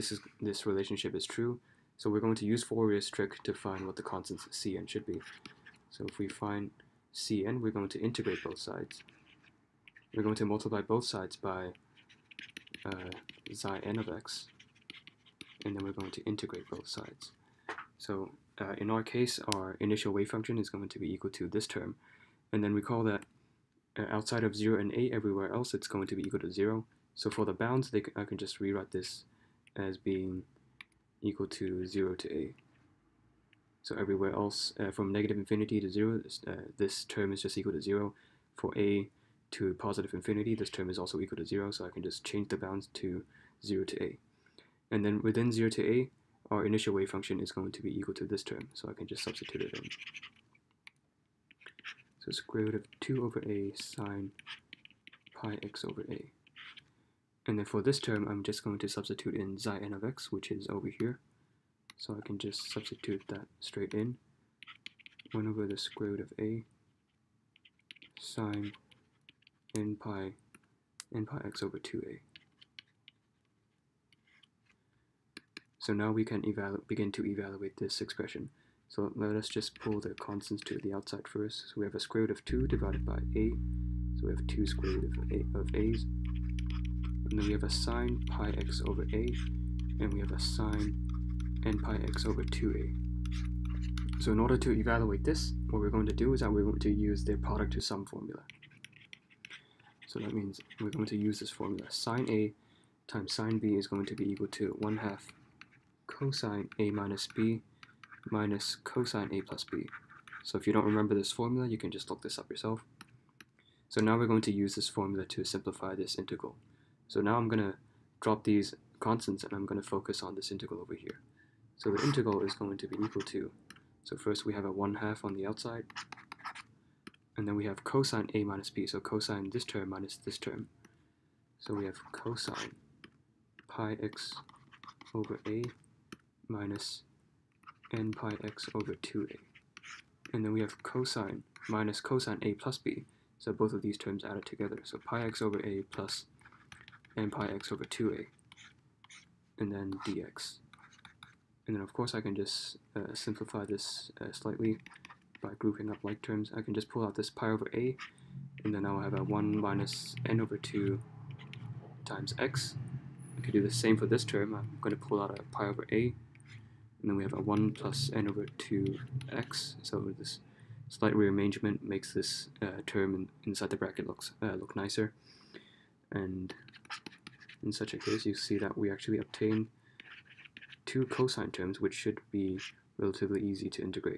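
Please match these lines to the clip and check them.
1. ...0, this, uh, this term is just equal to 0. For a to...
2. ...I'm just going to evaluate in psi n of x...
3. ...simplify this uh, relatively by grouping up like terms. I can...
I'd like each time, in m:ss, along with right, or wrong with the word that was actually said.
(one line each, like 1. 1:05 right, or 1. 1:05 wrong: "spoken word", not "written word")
1. 0:35 right
2. 0:58 wrong: "substitute", not "evaluate"
3. 2:33 wrong: "slightly", not "relatively".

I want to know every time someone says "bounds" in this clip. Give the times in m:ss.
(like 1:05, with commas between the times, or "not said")
0:27, 0:42.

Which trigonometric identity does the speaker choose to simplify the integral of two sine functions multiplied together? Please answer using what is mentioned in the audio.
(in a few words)
product to sum formula.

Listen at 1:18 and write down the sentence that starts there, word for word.
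So let us just pull the constants to the outside first.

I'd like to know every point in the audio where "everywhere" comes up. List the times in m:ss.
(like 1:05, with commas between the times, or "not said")
0:25, 0:33.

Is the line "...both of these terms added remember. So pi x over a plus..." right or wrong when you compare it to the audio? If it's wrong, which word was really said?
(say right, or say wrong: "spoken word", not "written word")
wrong: "together", not "remember".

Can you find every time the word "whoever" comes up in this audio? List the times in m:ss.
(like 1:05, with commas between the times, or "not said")
not said.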